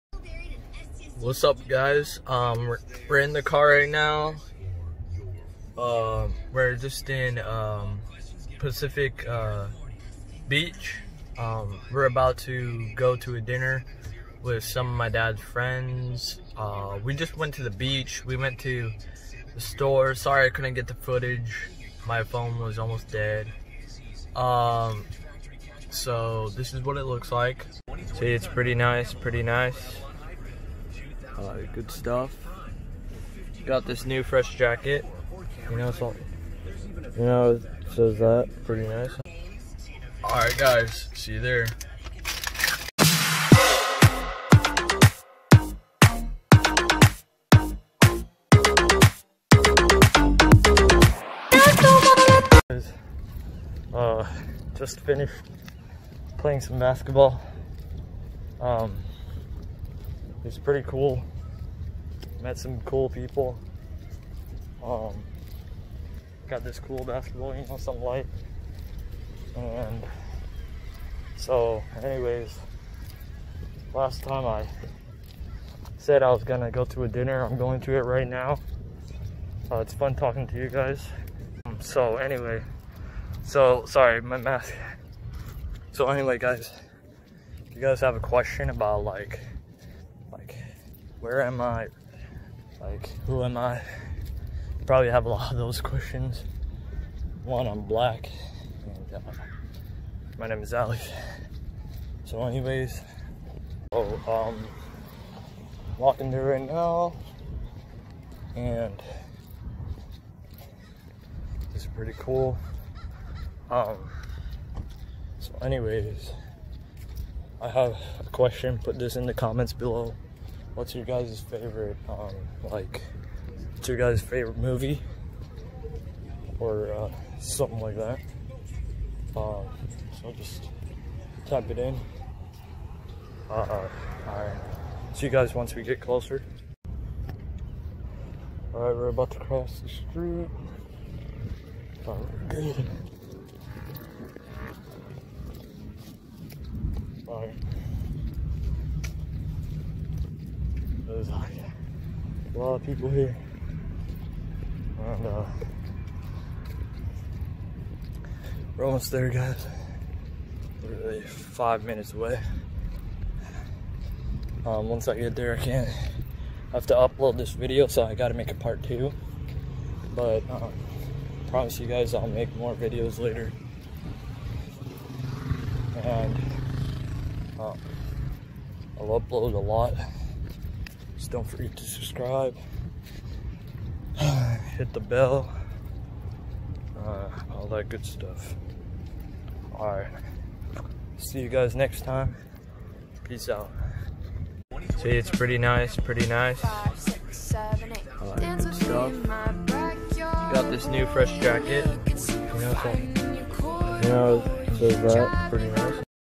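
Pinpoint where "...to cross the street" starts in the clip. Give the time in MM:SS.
02:19.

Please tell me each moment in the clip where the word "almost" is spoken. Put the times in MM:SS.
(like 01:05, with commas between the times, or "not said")
00:22, 02:38.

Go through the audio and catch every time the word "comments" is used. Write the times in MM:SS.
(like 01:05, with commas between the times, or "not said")
01:59.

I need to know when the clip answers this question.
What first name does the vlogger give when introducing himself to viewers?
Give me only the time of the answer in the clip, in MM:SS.
01:40.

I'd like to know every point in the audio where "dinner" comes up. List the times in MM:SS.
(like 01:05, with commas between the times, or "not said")
00:13, 01:17.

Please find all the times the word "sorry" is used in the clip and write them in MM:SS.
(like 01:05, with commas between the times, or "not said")
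00:20, 01:23.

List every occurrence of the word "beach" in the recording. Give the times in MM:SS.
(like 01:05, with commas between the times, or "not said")
00:10, 00:17.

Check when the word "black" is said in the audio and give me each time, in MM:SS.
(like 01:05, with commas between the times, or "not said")
01:37.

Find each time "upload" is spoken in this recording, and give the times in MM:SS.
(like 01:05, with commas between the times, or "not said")
02:46, 02:59.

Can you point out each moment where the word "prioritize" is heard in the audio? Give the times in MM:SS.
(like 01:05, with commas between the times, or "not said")
not said.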